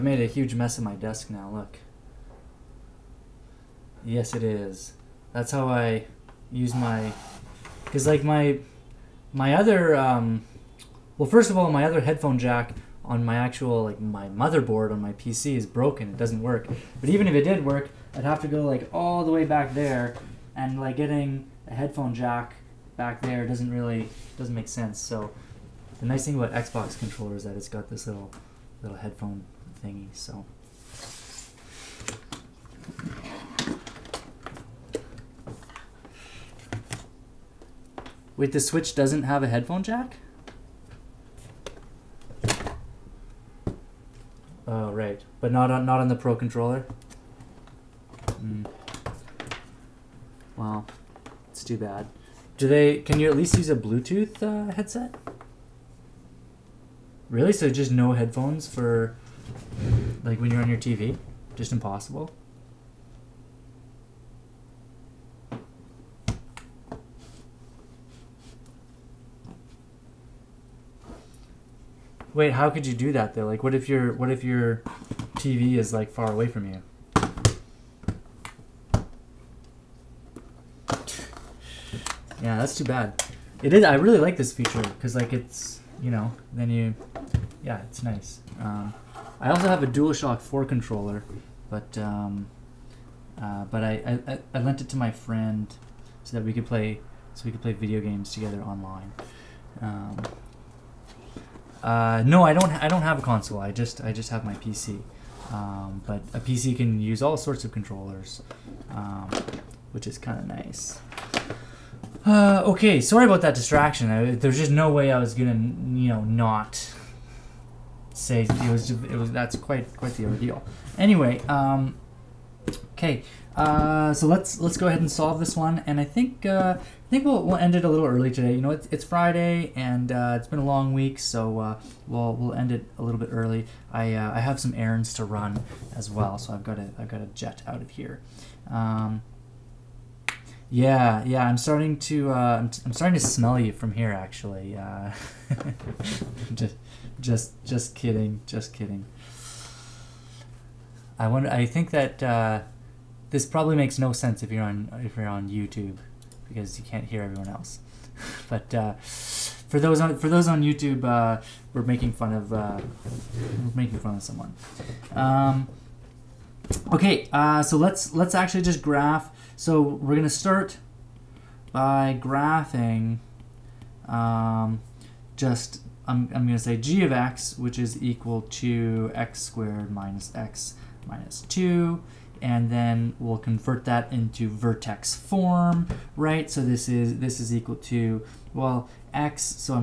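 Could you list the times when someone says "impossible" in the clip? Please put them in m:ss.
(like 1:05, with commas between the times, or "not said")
1:01.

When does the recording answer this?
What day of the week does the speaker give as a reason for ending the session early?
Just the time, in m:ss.
2:09.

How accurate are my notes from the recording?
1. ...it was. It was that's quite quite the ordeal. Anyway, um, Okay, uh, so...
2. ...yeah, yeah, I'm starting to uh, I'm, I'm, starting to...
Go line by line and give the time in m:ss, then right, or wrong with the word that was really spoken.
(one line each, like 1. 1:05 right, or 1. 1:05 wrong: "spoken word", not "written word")
1. 1:58 right
2. 2:20 right.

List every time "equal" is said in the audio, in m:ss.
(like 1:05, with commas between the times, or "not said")
2:58, 3:07.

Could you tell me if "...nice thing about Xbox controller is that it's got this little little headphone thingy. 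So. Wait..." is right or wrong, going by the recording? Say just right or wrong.
right.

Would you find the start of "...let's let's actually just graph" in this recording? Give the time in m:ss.
2:47.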